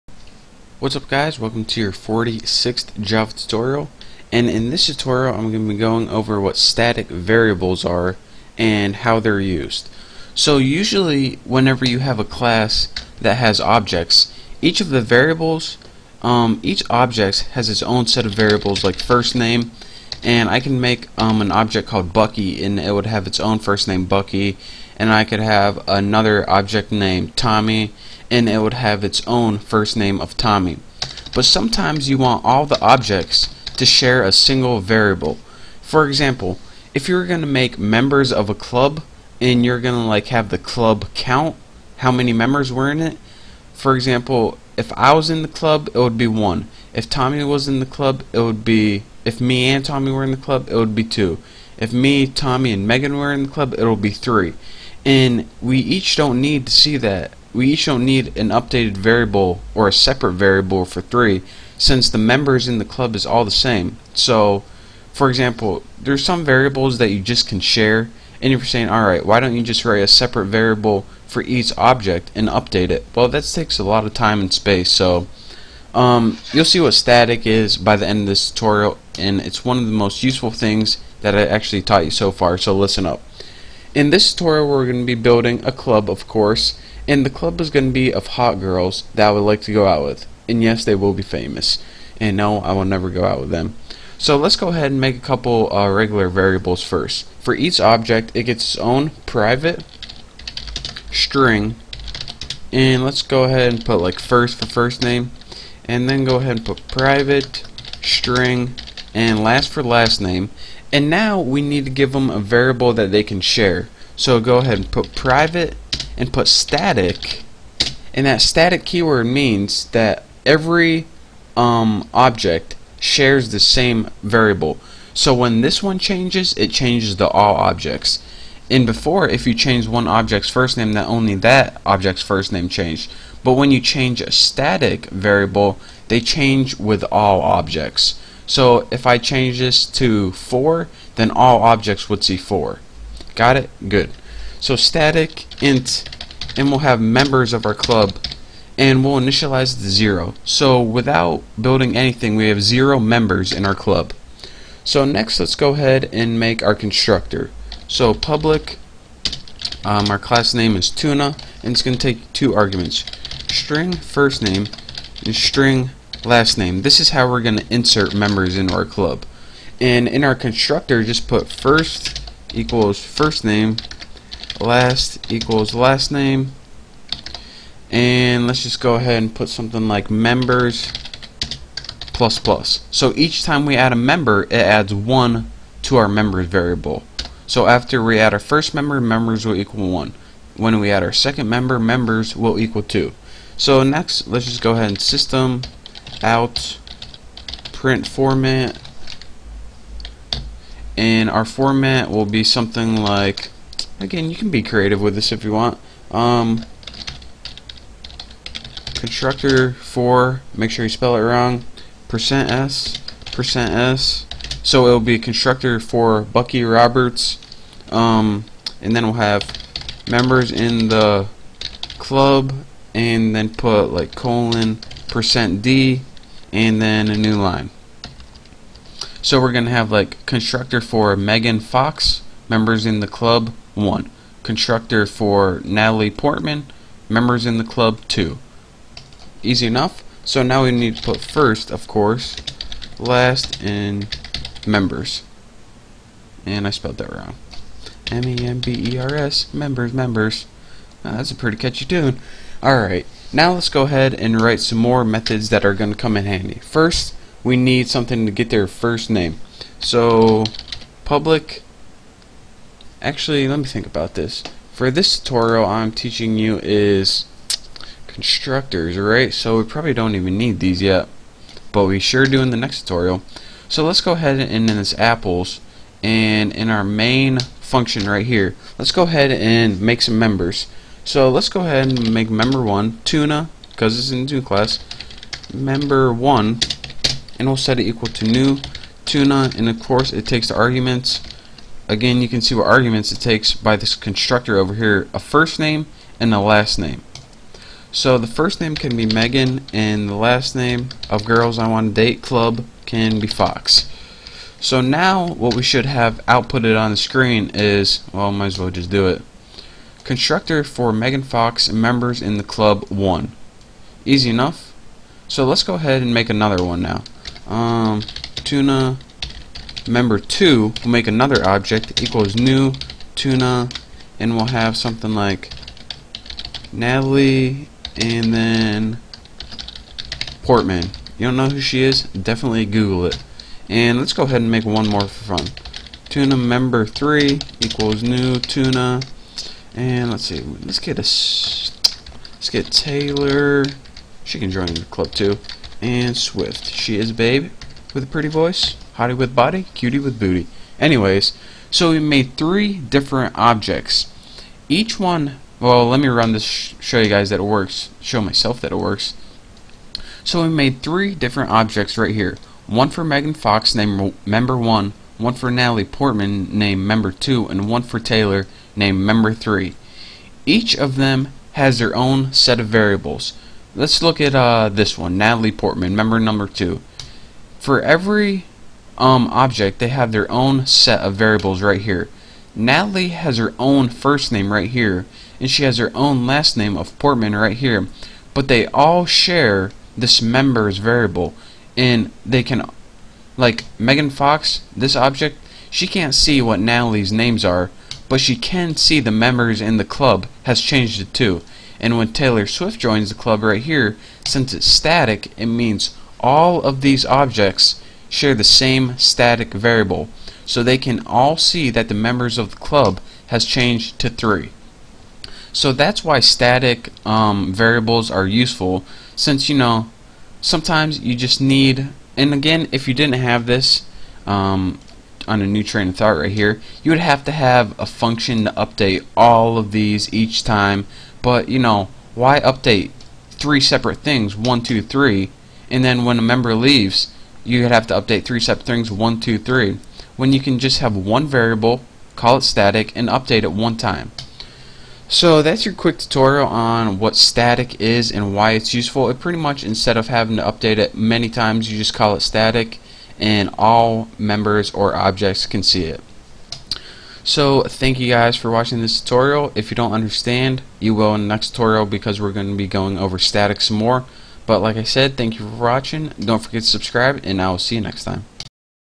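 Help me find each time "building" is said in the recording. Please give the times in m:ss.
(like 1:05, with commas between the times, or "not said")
1:25, 2:31.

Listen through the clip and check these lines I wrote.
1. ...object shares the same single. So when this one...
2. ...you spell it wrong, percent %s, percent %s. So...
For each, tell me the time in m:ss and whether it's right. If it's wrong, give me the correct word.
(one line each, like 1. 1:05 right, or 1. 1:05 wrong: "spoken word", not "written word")
1. 2:02 wrong: "variable", not "single"
2. 3:30 right.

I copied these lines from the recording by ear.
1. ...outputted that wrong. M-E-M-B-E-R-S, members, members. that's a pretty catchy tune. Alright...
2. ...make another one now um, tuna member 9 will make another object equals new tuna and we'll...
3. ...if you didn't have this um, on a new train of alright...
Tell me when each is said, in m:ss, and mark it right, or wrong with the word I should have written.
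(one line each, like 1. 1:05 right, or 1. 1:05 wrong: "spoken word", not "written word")
1. 4:06 wrong: "spelled", not "outputted"
2. 5:16 wrong: "2", not "9"
3. 7:02 wrong: "thought", not "alright".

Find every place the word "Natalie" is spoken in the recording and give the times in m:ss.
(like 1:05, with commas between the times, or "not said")
3:55, 5:26, 6:05, 6:15, 6:22, 6:36.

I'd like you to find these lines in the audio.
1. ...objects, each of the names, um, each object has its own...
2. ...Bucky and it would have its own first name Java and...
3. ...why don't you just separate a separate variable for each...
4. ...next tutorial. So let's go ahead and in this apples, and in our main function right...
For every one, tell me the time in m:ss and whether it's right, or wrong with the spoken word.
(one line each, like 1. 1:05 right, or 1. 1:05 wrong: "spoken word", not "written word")
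1. 0:13 wrong: "variables", not "names"
2. 0:22 wrong: "Bucky", not "Java"
3. 1:09 wrong: "write", not "separate"
4. 4:32 right.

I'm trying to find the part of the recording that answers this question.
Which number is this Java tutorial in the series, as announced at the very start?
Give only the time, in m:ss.
0:01.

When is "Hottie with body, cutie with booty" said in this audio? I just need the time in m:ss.
5:49.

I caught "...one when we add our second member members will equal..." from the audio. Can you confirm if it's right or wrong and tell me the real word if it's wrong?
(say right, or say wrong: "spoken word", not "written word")
right.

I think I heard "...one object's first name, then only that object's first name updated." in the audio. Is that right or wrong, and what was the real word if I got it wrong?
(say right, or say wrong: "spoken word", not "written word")
wrong: "changed", not "updated".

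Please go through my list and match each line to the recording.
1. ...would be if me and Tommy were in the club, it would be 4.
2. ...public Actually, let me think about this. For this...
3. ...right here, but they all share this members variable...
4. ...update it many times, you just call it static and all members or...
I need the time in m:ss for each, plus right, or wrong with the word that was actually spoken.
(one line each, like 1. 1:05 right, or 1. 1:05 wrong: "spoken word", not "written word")
1. 0:48 wrong: "2", not "4"
2. 4:21 right
3. 6:27 right
4. 7:30 right.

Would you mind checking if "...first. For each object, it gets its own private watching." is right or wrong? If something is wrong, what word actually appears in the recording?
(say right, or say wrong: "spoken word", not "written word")
wrong: "string", not "watching".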